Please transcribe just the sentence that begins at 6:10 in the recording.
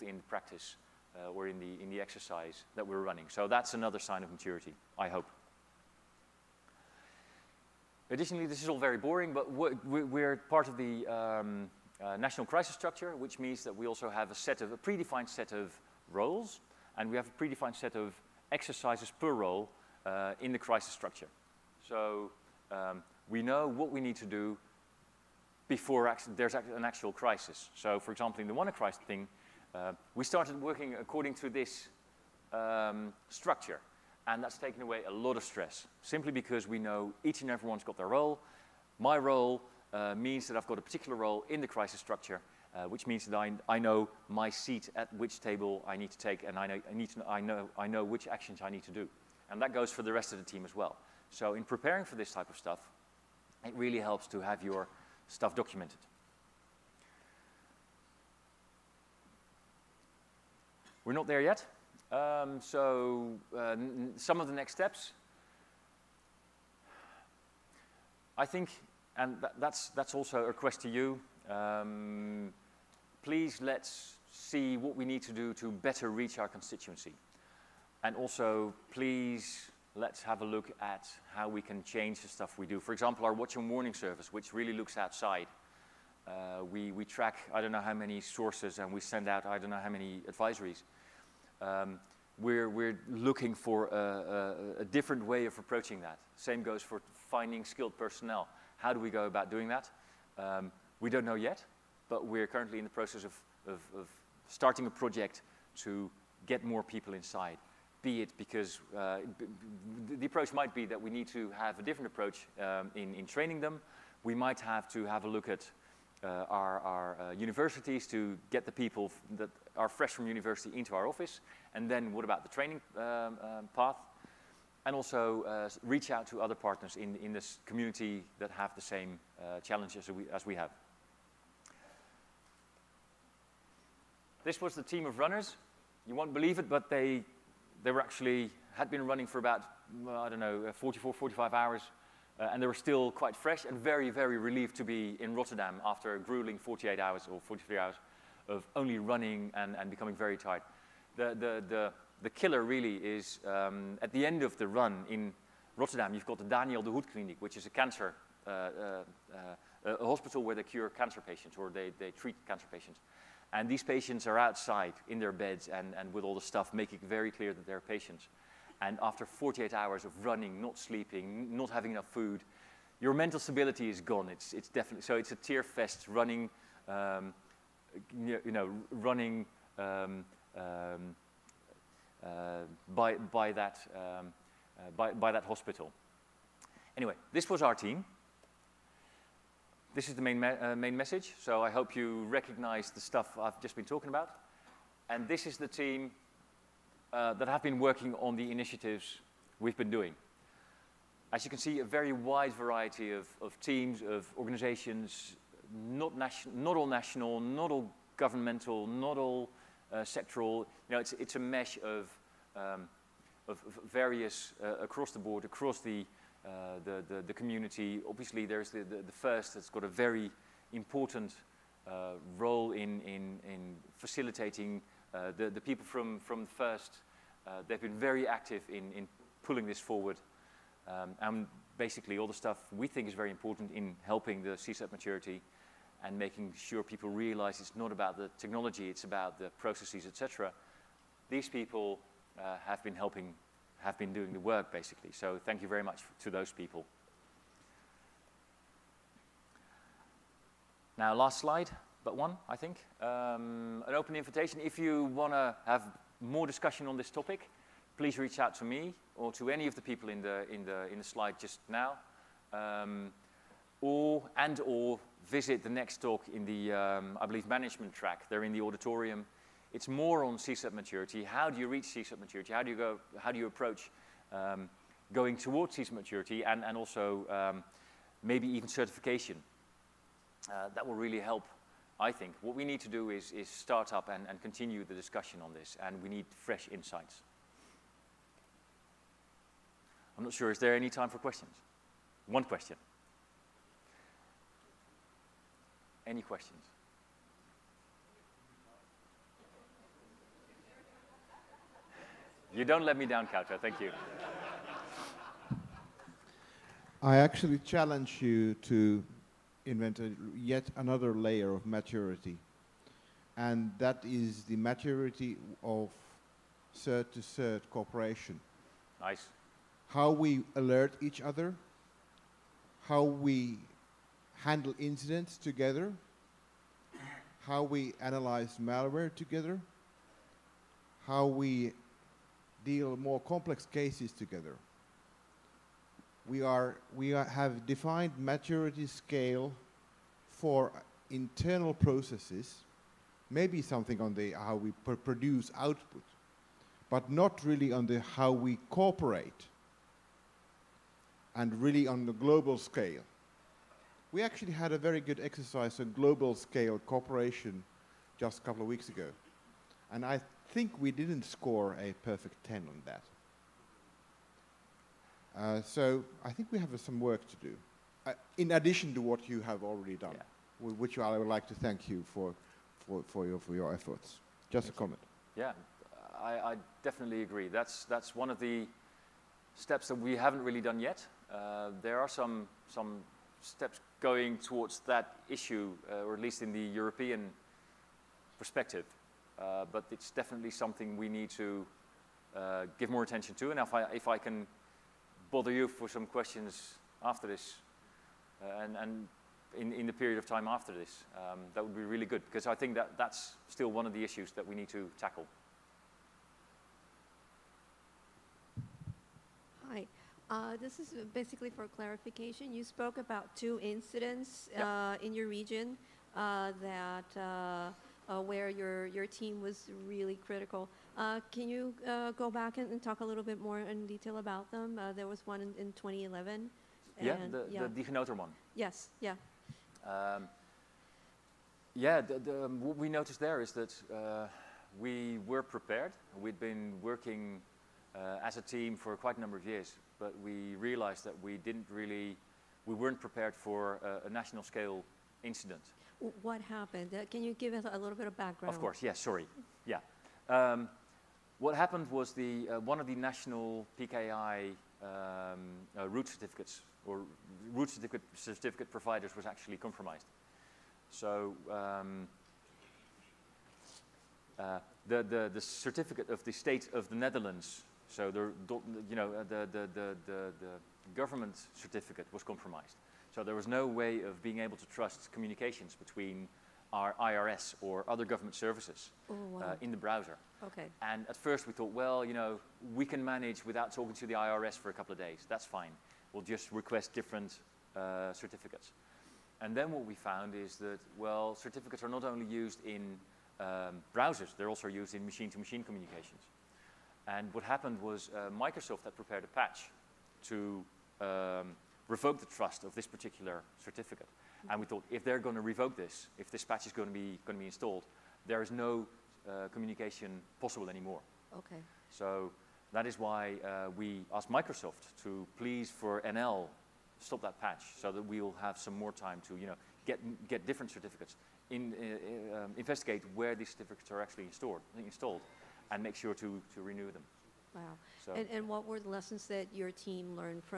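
which I would like to thank you for, for, for, your, for your efforts.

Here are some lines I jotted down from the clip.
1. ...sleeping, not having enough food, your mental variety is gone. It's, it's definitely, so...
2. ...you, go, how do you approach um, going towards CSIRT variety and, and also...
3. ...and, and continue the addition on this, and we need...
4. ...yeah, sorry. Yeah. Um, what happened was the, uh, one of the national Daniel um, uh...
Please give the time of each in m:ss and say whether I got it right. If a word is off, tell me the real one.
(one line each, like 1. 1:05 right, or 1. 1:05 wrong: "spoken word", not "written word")
1. 2:50 wrong: "stability", not "variety"
2. 4:32 wrong: "maturity", not "variety"
3. 4:44 wrong: "discussion", not "addition"
4. 7:28 wrong: "PKI", not "Daniel".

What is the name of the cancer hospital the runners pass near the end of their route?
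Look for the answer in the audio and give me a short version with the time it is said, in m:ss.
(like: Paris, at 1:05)
Daniel den Hoed Clinic, at 2:36.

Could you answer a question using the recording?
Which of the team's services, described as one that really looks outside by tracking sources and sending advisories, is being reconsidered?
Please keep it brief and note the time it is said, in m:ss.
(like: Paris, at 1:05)
watch and warning service, at 1:23.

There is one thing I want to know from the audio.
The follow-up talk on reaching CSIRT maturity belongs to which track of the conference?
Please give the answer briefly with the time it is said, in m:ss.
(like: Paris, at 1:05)
management track, at 4:27.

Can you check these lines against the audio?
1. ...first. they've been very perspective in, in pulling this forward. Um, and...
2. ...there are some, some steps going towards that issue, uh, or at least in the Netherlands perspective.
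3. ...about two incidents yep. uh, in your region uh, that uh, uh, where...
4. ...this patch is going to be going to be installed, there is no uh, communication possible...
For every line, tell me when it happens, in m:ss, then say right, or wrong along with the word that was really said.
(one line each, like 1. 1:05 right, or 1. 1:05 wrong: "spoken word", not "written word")
1. 3:46 wrong: "active", not "perspective"
2. 6:21 wrong: "European", not "Netherlands"
3. 6:52 right
4. 8:26 right.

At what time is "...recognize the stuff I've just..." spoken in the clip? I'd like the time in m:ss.
3:12.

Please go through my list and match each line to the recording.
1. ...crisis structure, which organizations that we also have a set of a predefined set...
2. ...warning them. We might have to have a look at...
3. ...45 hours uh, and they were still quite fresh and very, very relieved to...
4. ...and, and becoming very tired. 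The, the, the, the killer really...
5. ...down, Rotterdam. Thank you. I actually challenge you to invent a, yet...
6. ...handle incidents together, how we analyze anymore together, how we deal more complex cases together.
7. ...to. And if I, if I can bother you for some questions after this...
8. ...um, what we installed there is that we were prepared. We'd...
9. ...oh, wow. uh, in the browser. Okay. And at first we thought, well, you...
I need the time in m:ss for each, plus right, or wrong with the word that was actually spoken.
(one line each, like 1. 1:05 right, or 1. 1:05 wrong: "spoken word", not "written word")
1. 0:12 wrong: "means", not "organizations"
2. 1:53 wrong: "training", not "warning"
3. 2:21 right
4. 2:29 right
5. 5:03 wrong: "Kauta", not "Rotterdam"
6. 5:24 wrong: "malware", not "anymore"
7. 6:33 right
8. 7:12 wrong: "noticed", not "installed"
9. 7:59 right.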